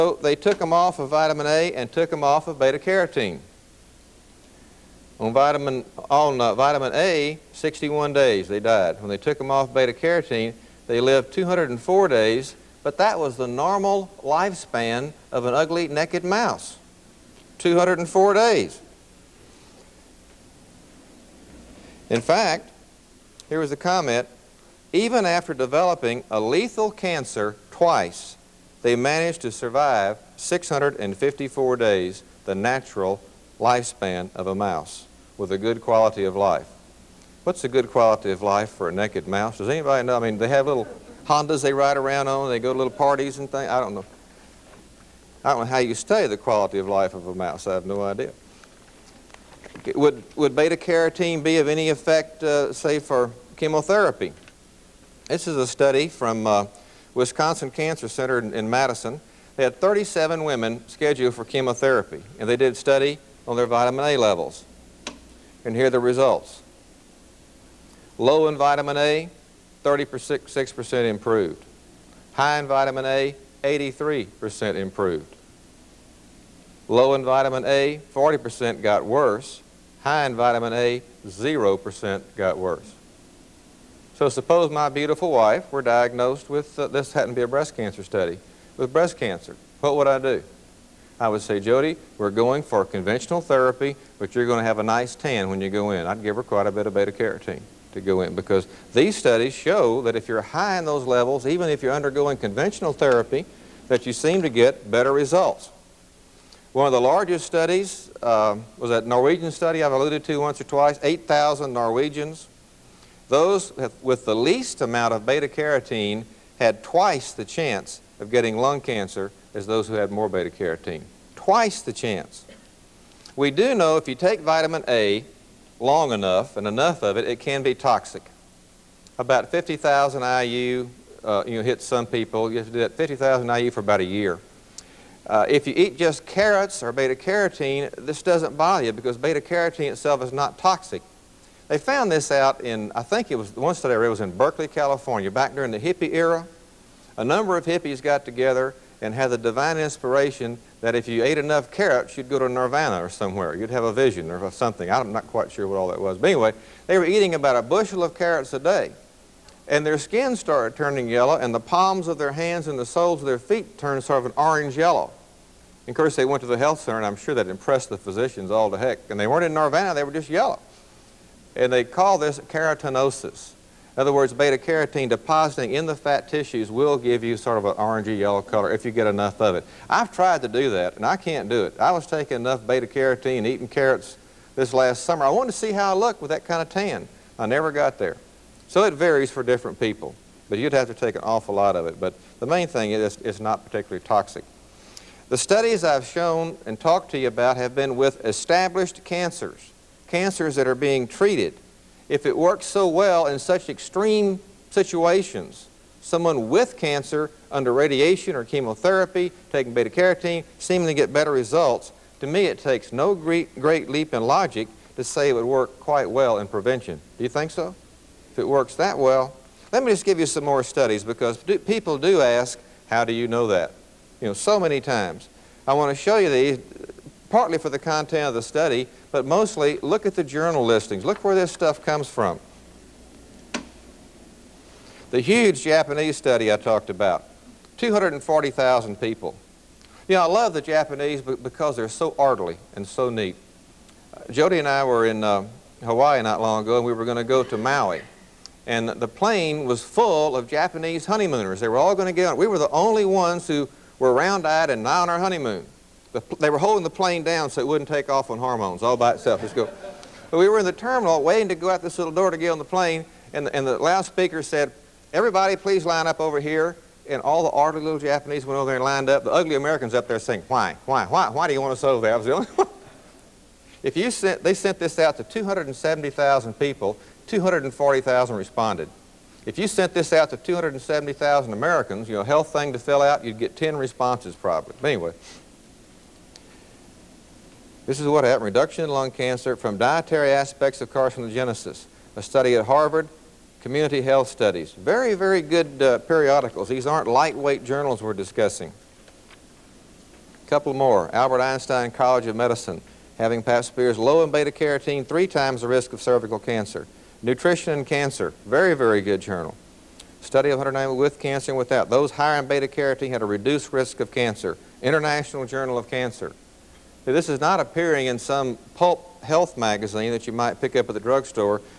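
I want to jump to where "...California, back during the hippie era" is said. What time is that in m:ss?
2:24.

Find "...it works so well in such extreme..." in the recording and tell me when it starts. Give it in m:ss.
3:22.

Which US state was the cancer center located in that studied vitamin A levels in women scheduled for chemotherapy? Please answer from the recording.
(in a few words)
Wisconsin.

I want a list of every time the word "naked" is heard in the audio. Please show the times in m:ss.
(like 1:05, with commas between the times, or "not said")
0:15, 0:38.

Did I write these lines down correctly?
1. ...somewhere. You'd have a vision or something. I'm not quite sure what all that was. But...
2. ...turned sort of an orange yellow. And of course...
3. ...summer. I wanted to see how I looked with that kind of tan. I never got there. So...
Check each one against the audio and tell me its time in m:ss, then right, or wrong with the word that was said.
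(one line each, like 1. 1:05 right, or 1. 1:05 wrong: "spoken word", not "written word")
1. 2:33 right
2. 2:43 right
3. 3:05 right.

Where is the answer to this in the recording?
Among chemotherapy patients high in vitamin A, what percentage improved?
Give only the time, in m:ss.
1:13.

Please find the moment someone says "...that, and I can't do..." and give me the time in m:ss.
3:00.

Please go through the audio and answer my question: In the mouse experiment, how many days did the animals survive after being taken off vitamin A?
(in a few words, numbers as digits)
61.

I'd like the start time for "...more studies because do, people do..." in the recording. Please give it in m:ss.
3:40.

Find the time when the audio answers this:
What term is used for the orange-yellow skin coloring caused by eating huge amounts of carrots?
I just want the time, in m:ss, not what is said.
2:52.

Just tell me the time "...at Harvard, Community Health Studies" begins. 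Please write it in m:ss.
4:52.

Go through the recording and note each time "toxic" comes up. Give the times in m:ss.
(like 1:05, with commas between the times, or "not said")
2:07, 2:20, 3:14.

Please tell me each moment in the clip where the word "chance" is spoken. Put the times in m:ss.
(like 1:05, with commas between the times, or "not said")
1:57, 2:01.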